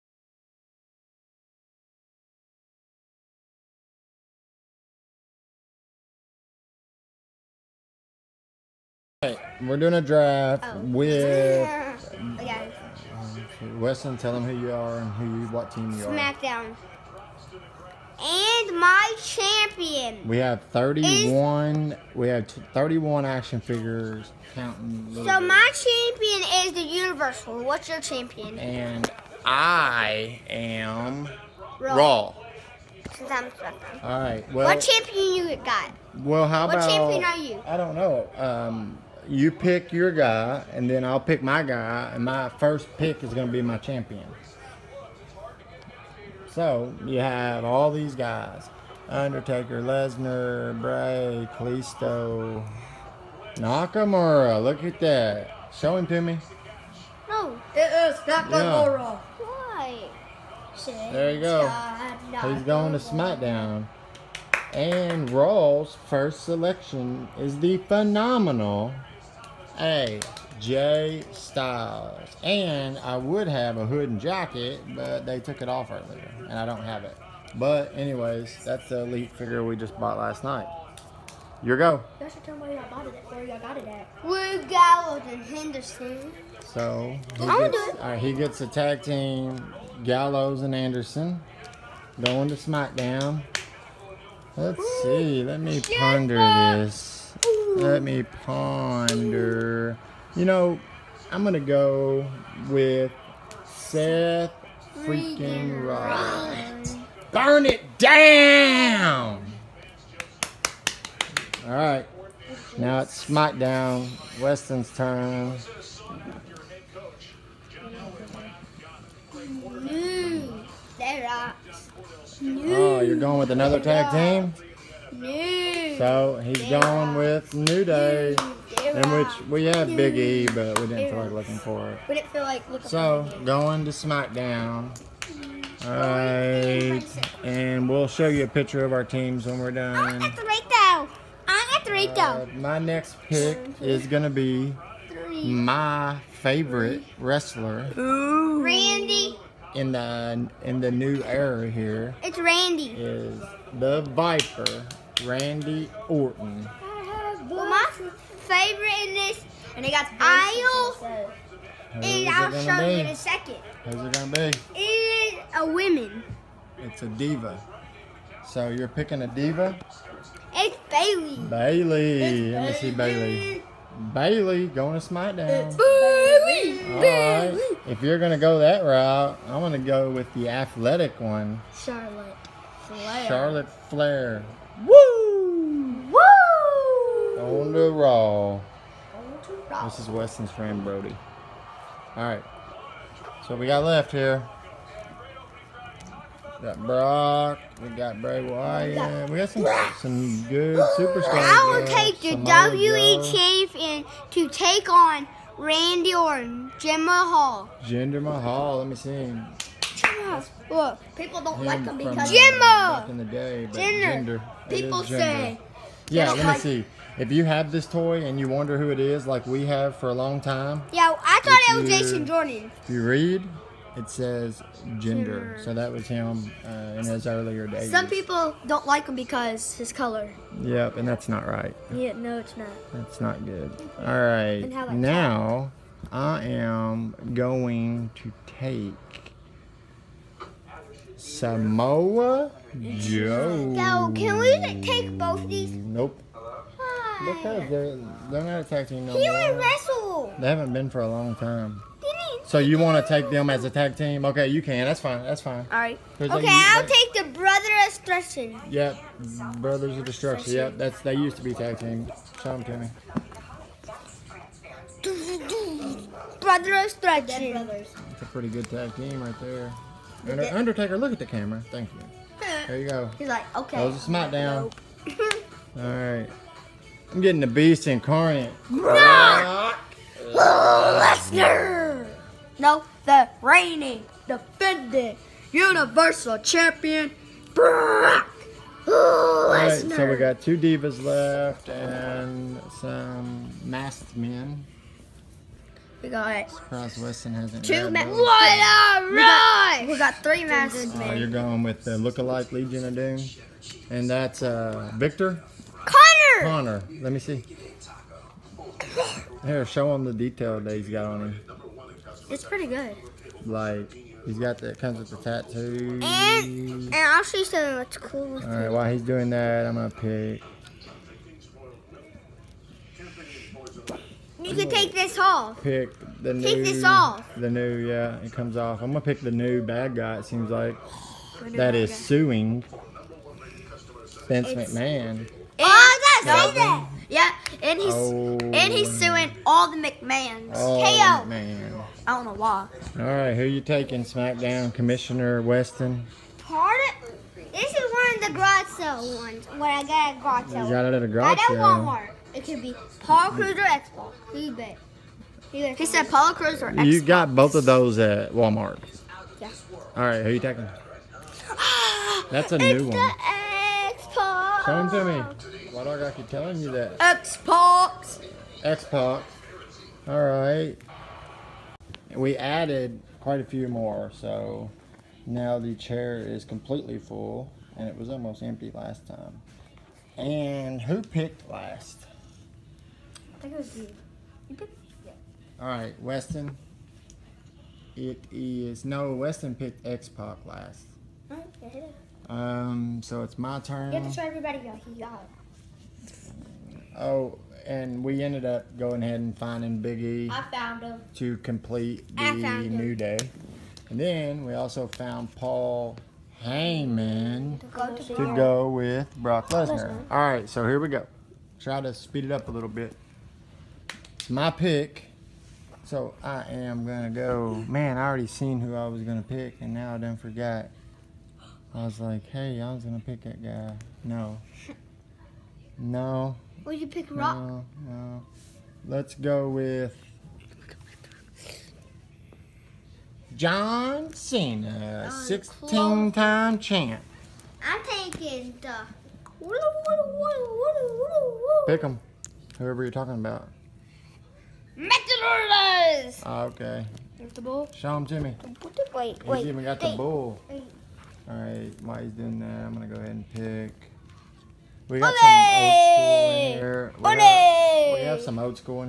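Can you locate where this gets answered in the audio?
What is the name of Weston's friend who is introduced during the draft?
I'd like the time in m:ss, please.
3:10.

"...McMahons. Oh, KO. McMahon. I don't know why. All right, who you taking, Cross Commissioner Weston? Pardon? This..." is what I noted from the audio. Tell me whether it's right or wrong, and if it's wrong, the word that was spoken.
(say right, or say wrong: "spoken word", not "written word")
wrong: "SmackDown", not "Cross".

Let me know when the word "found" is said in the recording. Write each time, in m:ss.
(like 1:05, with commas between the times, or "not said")
6:40, 6:44.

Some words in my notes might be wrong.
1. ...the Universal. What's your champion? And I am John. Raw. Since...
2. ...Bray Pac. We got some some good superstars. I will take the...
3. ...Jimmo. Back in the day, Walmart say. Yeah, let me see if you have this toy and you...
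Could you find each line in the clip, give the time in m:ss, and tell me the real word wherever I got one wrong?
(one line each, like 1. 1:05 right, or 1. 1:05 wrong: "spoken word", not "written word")
1. 0:26 wrong: "Raw", not "John"
2. 3:18 wrong: "Wyatt", not "Pac"
3. 3:32 wrong: "People", not "Walmart".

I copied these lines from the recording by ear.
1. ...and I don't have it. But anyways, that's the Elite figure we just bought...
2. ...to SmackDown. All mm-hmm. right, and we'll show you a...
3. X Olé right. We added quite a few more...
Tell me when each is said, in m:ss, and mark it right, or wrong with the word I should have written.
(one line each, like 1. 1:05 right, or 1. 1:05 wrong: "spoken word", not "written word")
1. 1:16 right
2. 2:13 right
3. 6:08 wrong: "All", not "Olé".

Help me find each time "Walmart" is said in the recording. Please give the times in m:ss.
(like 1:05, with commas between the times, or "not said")
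5:52, 5:58.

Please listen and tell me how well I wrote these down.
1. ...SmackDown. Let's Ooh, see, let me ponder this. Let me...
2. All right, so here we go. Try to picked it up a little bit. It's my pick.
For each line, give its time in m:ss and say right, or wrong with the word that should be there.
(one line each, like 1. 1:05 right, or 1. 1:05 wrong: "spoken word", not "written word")
1. 1:32 right
2. 6:50 wrong: "speed", not "picked".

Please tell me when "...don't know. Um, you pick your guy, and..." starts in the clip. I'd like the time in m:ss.
0:37.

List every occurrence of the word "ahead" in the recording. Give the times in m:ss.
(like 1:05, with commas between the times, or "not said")
6:39, 7:32.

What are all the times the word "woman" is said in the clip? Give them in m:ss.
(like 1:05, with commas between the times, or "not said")
2:45.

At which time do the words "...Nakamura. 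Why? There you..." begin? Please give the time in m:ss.
0:58.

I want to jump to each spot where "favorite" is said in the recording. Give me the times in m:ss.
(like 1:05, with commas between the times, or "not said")
2:26, 2:37.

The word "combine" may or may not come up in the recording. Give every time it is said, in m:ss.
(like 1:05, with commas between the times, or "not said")
not said.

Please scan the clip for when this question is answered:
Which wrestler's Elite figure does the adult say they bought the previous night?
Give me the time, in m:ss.
1:09.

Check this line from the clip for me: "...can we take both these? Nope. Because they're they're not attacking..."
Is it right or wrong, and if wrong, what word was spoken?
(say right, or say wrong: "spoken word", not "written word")
right.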